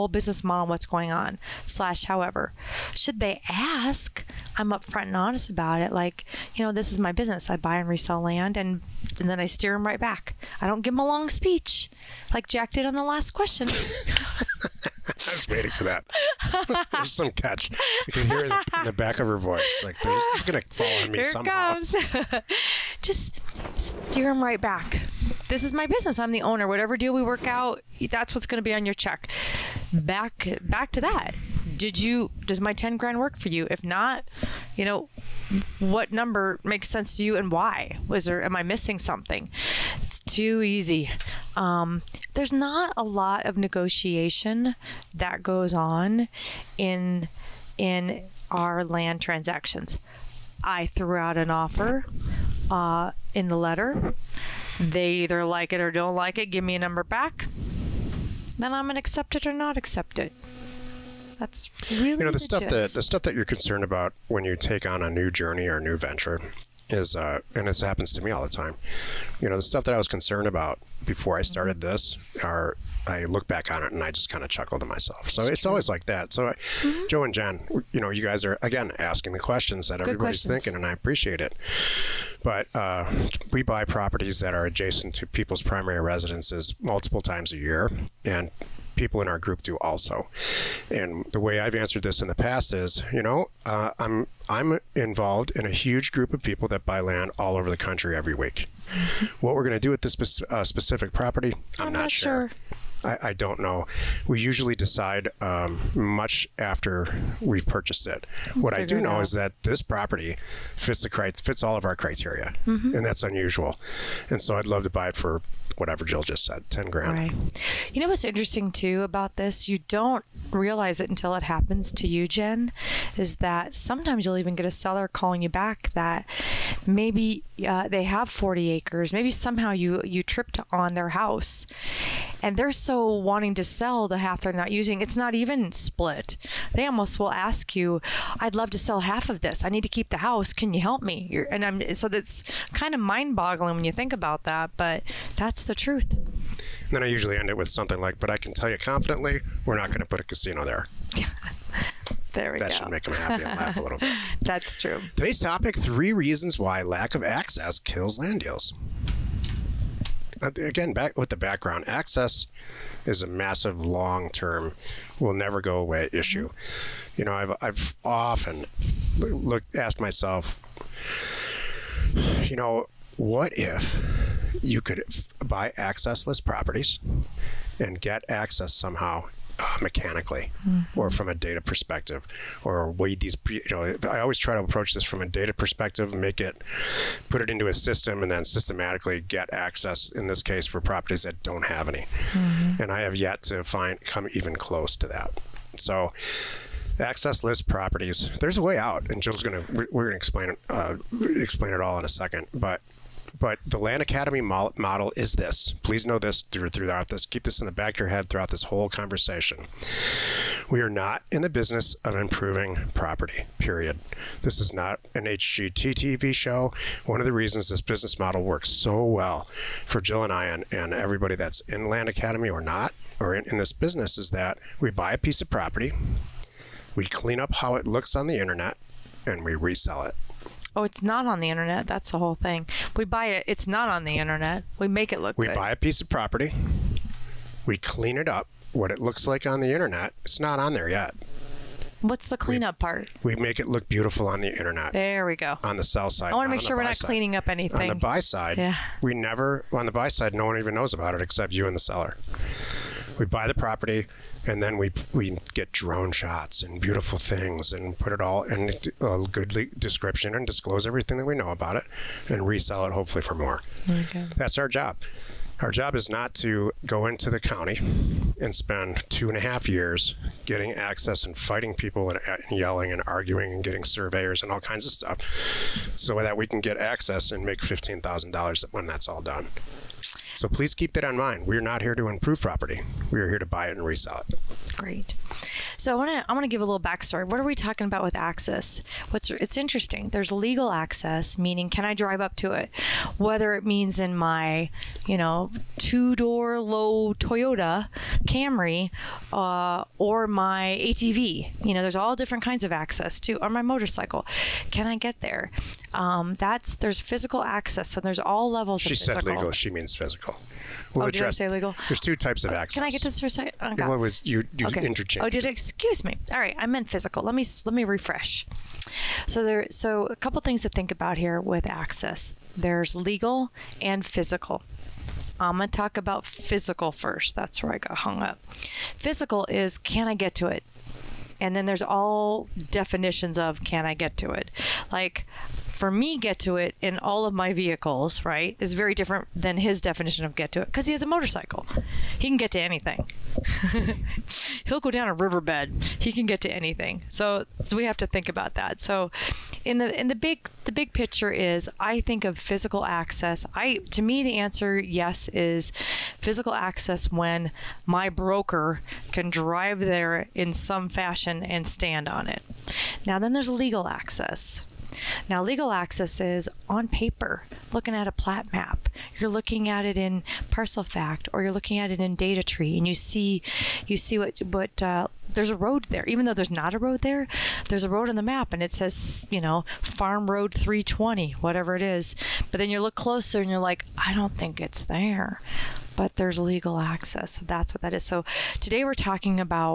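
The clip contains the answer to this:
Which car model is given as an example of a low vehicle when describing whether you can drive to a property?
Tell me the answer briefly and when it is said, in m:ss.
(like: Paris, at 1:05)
Toyota Camry, at 4:57.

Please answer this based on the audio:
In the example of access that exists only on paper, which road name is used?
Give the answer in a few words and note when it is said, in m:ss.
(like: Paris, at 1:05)
Farm Road 320, at 6:19.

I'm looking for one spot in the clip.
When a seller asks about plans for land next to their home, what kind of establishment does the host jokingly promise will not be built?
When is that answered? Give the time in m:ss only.
2:30.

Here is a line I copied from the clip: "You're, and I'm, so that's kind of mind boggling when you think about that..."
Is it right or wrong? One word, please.
right.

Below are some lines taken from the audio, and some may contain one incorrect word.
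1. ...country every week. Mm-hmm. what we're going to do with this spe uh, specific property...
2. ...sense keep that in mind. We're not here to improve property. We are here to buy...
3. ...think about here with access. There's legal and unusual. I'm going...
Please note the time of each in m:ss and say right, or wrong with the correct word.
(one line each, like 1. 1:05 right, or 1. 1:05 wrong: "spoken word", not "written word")
1. 1:37 right
2. 4:40 wrong: "please", not "sense"
3. 5:20 wrong: "physical", not "unusual".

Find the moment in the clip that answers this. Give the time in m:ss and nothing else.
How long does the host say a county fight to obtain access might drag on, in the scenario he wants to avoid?
4:29.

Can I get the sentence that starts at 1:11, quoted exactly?
this are I look back on it and I just kind of chuckle to myself.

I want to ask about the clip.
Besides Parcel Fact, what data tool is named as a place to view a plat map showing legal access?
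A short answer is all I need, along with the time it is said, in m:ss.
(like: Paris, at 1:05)
DataTree, at 6:12.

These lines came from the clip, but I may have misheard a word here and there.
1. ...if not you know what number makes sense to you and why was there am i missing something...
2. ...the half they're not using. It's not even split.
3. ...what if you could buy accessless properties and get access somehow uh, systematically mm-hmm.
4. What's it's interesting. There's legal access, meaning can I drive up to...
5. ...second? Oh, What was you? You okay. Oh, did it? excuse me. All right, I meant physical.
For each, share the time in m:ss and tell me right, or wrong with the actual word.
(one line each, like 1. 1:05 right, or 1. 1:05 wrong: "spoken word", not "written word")
1. 0:33 right
2. 2:14 right
3. 2:53 wrong: "mechanically", not "systematically"
4. 4:49 right
5. 5:13 right.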